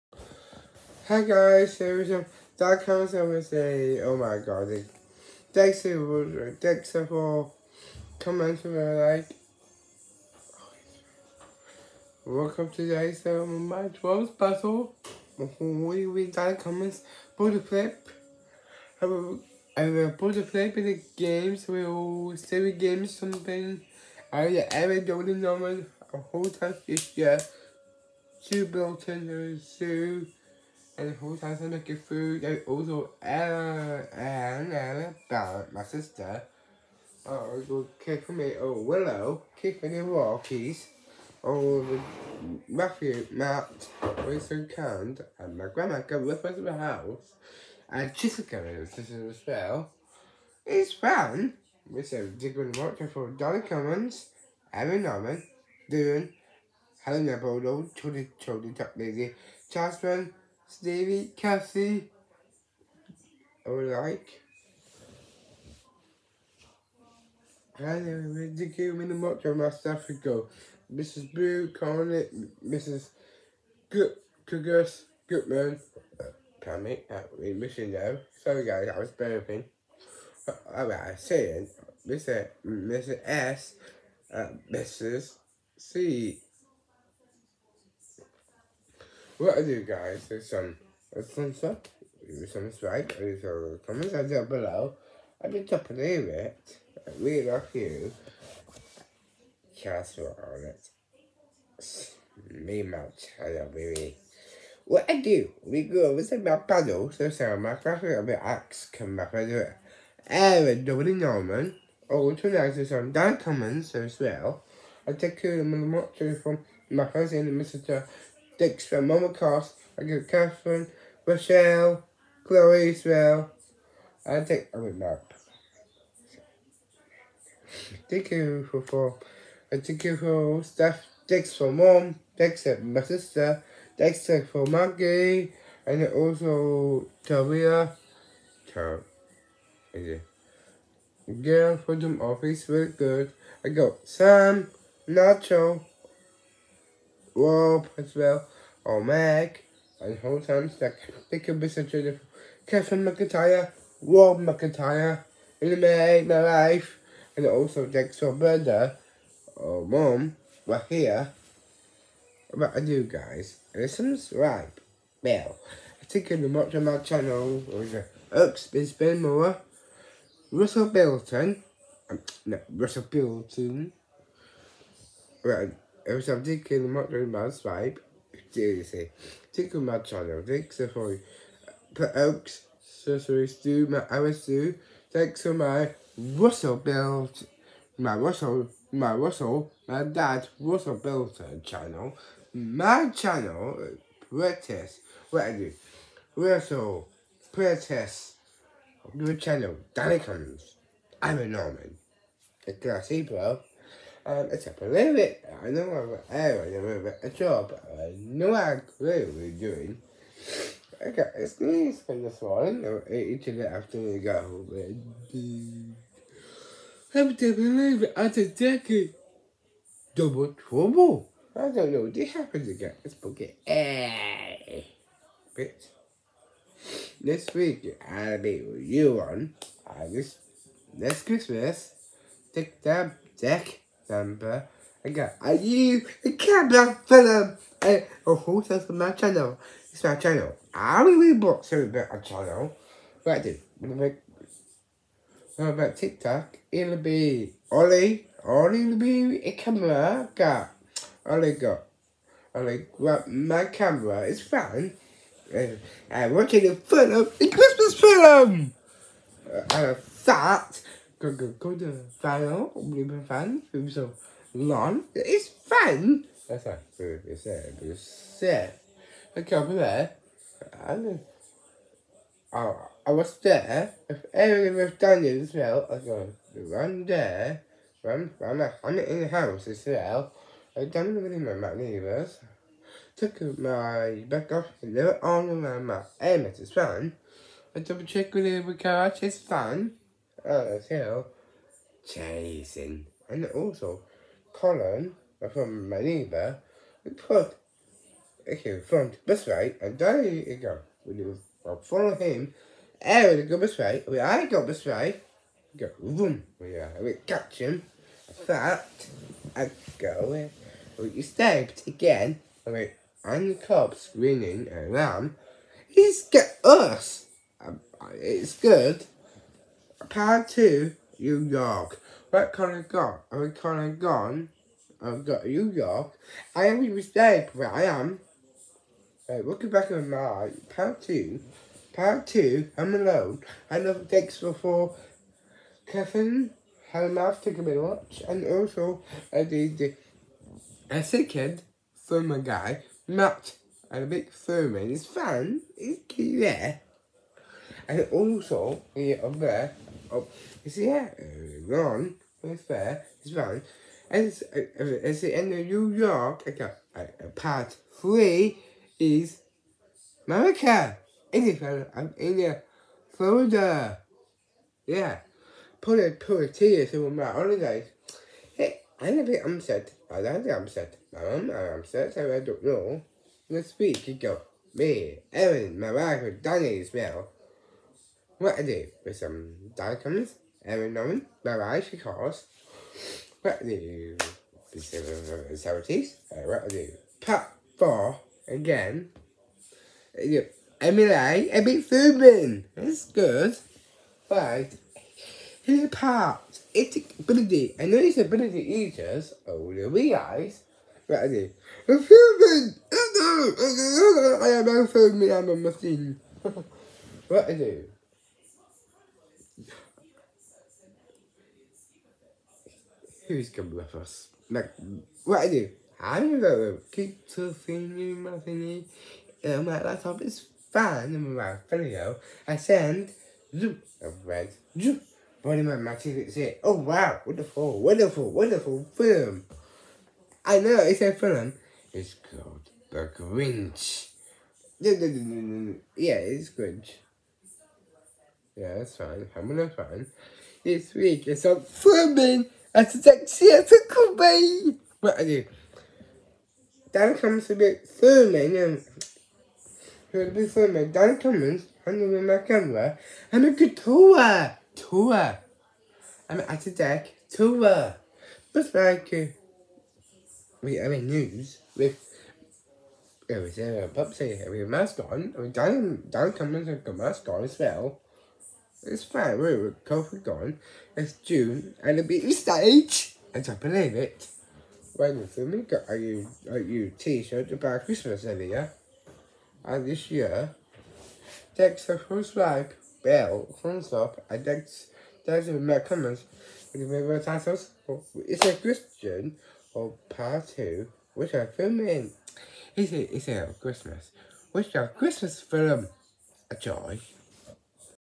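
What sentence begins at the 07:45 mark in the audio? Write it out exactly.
Oh, Dan Dan Cummins had a mask on as well.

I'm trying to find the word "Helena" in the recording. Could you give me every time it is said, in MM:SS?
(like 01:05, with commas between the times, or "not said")
00:57.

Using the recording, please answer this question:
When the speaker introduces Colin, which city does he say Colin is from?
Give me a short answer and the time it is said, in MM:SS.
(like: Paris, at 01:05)
Manila, at 04:55.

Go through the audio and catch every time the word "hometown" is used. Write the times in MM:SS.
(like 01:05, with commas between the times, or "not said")
02:30.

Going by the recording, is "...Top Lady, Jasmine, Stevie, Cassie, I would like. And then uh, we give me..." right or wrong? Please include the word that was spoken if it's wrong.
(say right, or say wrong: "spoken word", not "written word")
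right.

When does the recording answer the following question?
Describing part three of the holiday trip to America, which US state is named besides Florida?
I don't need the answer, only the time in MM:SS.
06:01.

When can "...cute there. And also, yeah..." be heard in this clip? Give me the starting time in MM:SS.
05:46.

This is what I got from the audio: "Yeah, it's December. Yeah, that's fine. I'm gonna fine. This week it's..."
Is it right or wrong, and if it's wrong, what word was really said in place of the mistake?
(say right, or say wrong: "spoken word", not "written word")
wrong: "Grinch", not "December".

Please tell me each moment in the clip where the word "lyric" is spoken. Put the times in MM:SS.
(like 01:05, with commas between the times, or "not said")
03:24.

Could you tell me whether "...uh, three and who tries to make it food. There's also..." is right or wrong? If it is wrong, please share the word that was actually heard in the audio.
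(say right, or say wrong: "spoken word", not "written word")
wrong: "two", not "three".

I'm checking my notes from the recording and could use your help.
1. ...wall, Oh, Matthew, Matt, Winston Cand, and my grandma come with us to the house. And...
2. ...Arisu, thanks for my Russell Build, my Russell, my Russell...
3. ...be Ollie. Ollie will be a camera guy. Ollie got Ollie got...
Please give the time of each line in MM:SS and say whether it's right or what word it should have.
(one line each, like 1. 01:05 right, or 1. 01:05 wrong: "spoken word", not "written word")
1. 00:40 right
2. 03:04 right
3. 04:06 right.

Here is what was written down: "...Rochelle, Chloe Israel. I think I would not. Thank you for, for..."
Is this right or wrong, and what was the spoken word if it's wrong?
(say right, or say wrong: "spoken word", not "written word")
right.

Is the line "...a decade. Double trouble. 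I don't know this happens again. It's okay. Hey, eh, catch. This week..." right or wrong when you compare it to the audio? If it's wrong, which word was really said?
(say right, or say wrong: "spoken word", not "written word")
wrong: "bitch", not "catch".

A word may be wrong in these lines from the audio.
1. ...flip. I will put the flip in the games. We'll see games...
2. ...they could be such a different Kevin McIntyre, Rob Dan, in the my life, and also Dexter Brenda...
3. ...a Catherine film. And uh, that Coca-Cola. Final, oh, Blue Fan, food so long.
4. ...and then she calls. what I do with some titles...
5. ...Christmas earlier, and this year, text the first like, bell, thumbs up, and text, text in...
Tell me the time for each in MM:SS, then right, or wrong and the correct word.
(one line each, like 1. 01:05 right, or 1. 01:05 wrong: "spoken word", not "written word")
1. 00:17 right
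2. 02:31 wrong: "McIntyre", not "Dan"
3. 04:17 wrong: "Christmas", not "Catherine"
4. 06:21 wrong: "celebrities", not "titles"
5. 07:57 right.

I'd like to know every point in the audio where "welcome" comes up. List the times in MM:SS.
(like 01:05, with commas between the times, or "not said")
00:12, 05:29.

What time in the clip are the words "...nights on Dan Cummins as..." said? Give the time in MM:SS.
01:52.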